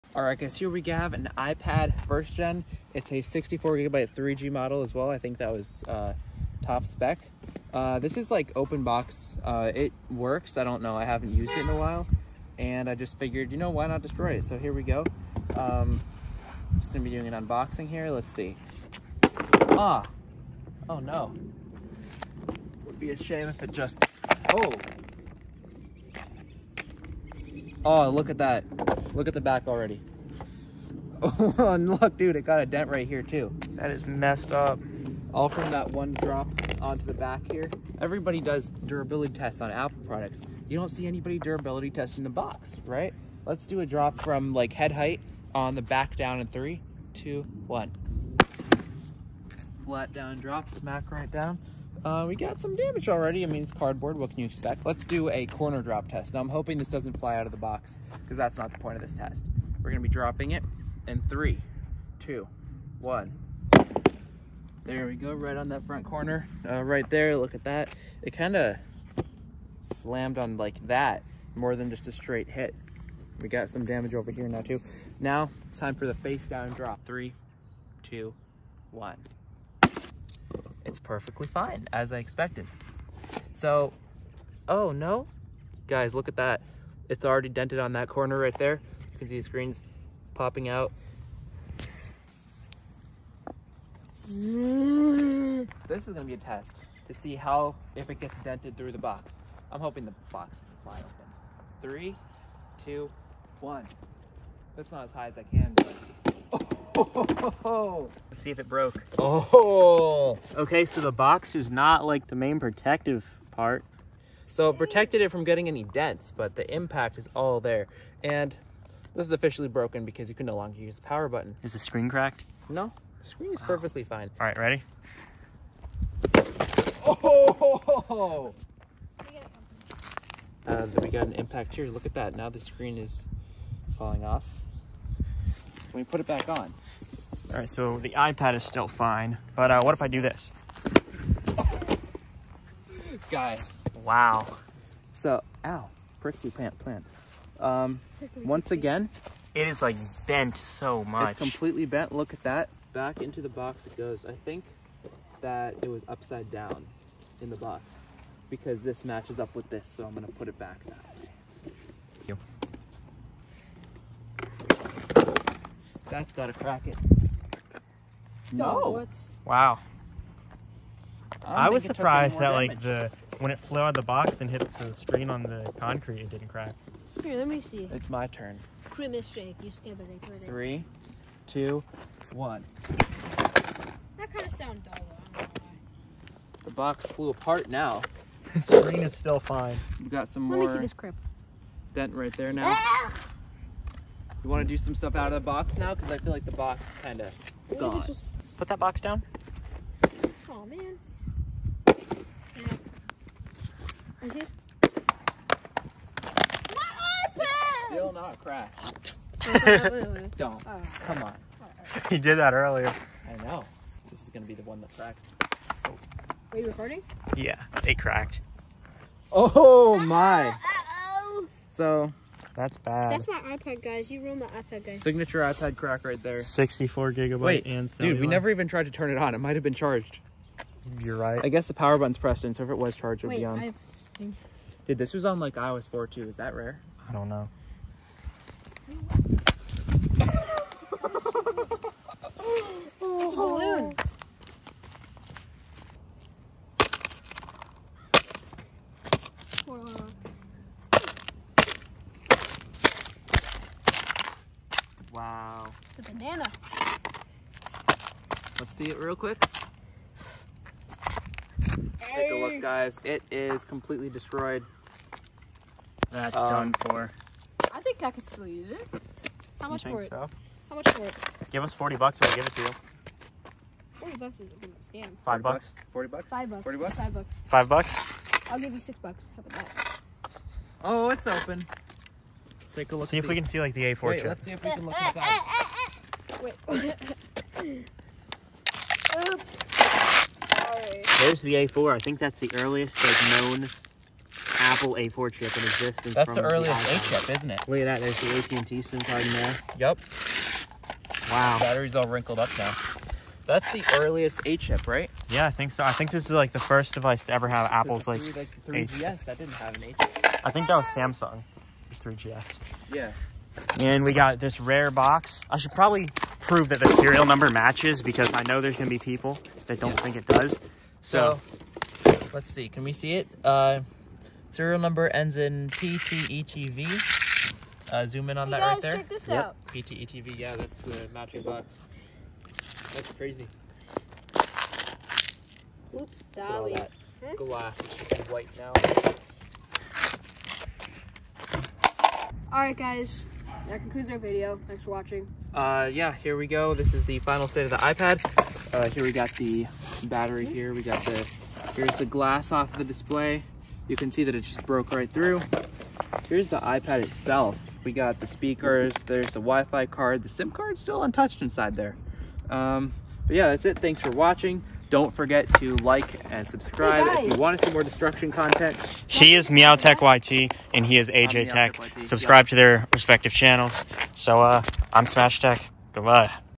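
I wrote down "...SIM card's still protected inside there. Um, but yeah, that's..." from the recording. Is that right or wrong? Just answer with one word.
wrong.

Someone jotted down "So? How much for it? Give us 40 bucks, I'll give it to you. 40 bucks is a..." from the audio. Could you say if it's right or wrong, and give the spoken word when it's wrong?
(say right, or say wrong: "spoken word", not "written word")
right.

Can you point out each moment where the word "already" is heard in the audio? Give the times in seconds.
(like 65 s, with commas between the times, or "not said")
29 s, 53 s, 87 s.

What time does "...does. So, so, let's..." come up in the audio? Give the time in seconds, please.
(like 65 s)
320 s.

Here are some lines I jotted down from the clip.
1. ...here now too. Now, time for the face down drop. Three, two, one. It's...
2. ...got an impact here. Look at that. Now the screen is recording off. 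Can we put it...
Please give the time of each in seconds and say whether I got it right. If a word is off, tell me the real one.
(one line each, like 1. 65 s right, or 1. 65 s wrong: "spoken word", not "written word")
1. 74 s right
2. 131 s wrong: "falling", not "recording".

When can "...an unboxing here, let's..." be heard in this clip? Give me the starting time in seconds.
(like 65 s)
17 s.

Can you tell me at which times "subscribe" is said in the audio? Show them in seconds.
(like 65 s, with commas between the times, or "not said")
366 s, 372 s.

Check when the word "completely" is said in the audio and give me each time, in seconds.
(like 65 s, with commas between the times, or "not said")
151 s, 263 s.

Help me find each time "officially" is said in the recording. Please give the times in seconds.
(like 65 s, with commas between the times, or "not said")
119 s.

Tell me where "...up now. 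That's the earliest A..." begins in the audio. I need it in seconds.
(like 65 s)
302 s.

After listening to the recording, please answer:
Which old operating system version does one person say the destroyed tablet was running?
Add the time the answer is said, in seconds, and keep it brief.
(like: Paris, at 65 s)
iOS 4, at 235 s.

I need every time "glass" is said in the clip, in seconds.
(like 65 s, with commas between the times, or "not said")
337 s, 352 s.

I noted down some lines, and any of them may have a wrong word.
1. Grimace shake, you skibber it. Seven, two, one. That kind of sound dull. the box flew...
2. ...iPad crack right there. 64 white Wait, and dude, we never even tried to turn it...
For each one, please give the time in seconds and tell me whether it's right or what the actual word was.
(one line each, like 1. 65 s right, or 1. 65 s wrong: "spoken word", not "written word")
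1. 178 s wrong: "Three", not "Seven"
2. 225 s wrong: "gigabyte", not "white".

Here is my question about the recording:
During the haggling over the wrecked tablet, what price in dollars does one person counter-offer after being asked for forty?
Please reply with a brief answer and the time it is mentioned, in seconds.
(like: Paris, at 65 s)
6, at 278 s.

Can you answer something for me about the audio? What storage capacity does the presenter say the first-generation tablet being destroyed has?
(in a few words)
64 gigabytes.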